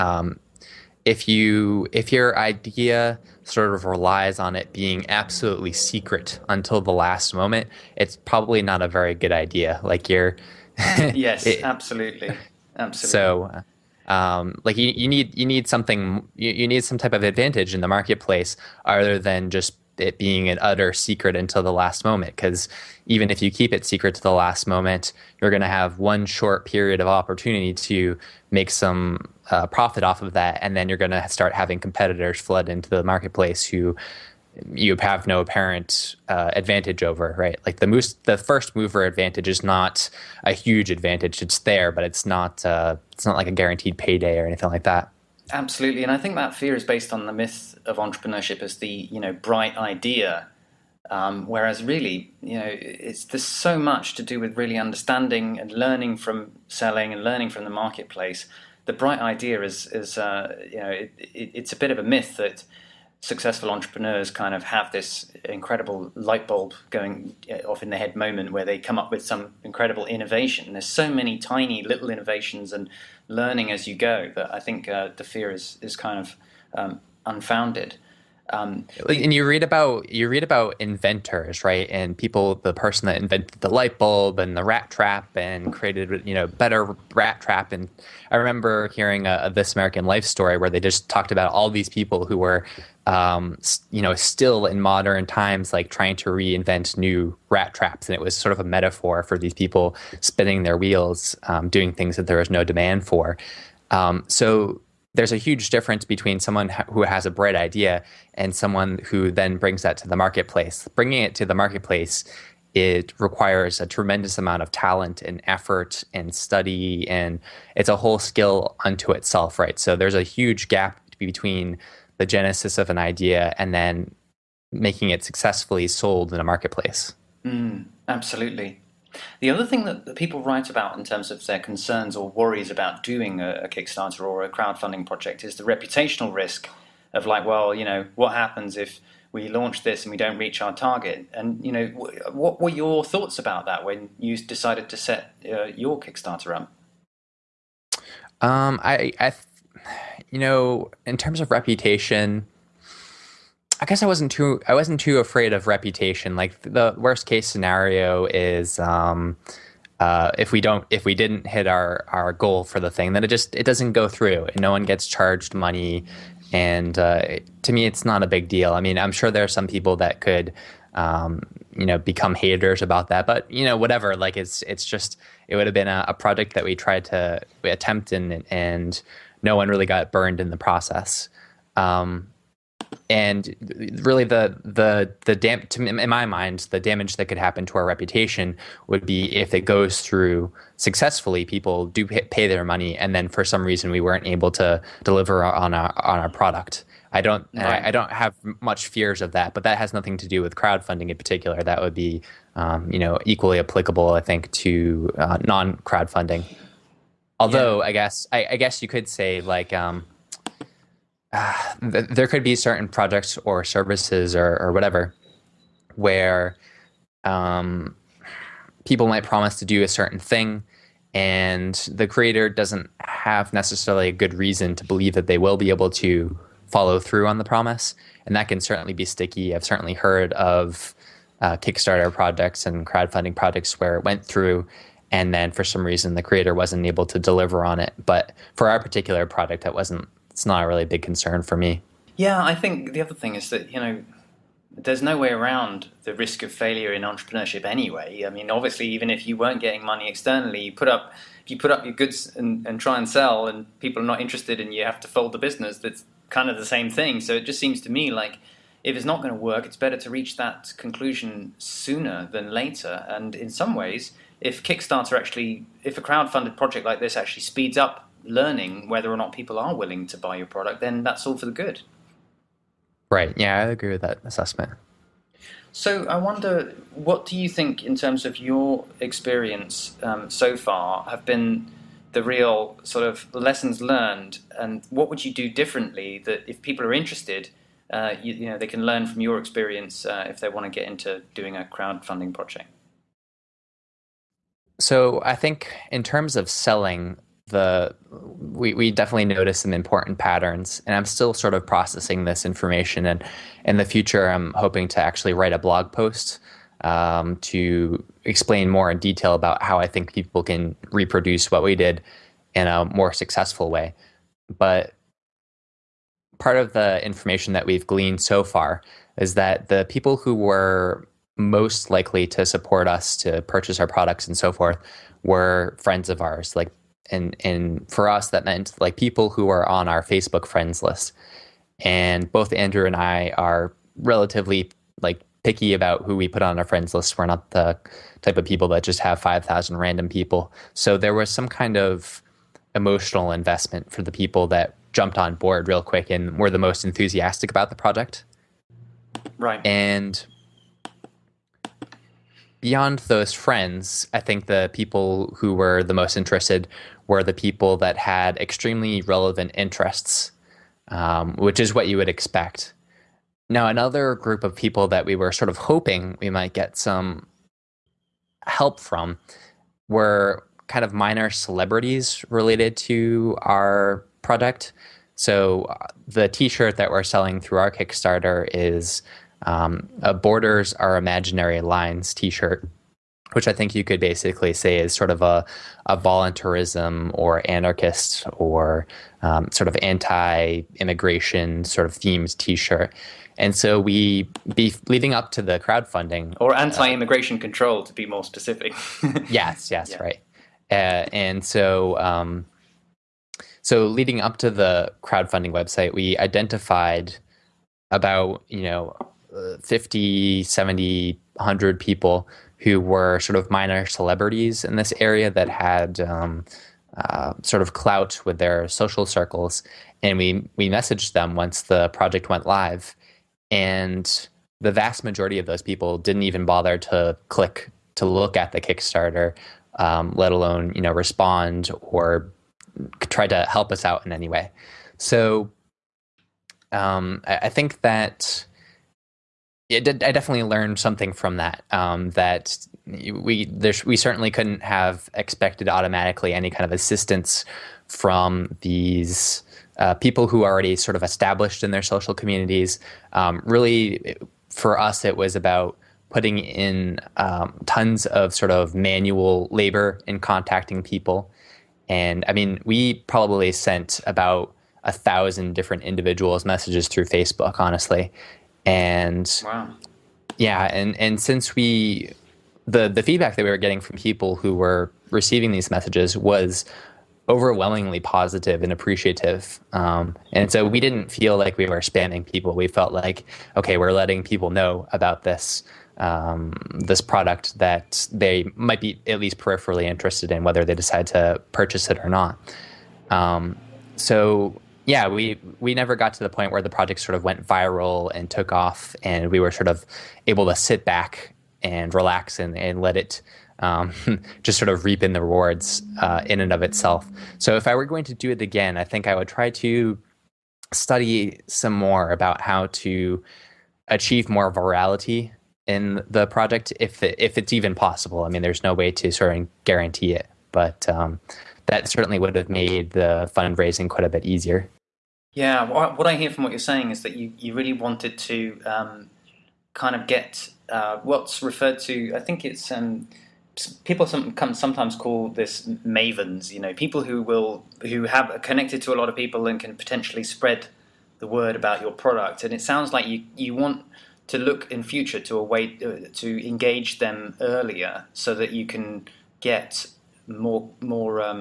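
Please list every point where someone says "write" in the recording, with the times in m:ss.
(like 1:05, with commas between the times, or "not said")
2:10, 5:05.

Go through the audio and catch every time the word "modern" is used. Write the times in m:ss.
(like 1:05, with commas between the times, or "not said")
1:34.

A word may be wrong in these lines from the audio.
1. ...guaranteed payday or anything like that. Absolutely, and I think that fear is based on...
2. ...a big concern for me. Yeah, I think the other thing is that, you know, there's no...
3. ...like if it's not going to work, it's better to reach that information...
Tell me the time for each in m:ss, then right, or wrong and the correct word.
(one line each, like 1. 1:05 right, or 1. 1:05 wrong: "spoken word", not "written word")
1. 0:43 right
2. 4:00 right
3. 4:18 wrong: "conclusion", not "information".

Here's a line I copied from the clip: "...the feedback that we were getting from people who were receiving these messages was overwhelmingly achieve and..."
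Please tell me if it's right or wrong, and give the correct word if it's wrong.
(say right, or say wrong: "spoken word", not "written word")
wrong: "positive", not "achieve".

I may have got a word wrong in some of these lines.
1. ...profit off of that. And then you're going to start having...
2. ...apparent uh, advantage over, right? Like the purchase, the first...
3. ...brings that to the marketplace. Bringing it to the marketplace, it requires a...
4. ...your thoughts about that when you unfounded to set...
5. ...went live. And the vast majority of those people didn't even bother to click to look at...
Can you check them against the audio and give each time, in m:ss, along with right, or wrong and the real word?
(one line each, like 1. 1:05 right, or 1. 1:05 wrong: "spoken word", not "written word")
1. 0:29 right
2. 0:35 wrong: "moose", not "purchase"
3. 1:49 right
4. 2:22 wrong: "decided", not "unfounded"
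5. 7:02 right.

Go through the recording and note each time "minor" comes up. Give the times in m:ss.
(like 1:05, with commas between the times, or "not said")
6:10, 6:53.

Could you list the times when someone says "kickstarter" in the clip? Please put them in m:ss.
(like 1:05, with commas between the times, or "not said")
2:13, 2:25, 3:51, 4:24, 6:17, 7:08.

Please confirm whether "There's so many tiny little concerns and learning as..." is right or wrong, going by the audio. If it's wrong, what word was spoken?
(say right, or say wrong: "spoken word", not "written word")
wrong: "innovations", not "concerns".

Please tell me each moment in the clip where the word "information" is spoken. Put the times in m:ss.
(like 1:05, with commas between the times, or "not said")
5:02, 5:17.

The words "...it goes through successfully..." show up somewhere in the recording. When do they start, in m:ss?
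3:09.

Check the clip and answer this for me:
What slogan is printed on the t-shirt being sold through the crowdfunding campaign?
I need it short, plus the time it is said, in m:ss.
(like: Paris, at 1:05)
Borders Are Imaginary Lines, at 6:20.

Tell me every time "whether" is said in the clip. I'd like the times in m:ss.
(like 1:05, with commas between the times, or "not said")
4:28, 8:10.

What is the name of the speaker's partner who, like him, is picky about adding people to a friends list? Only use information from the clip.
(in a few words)
Andrew.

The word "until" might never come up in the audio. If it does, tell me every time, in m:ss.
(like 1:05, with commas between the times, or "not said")
0:06, 0:21.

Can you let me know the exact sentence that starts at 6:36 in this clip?
Or anti immigration uh, control, to be more specific.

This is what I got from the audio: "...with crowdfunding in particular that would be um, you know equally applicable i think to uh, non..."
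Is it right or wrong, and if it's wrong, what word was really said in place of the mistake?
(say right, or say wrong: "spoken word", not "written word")
right.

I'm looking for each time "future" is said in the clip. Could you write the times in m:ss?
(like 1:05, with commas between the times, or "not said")
5:03, 9:04.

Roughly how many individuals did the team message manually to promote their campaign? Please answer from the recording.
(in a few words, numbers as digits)
about a thousand.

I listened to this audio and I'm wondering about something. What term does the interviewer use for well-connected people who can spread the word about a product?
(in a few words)
mavens.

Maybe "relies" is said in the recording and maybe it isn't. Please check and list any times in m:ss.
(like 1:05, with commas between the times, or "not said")
0:03.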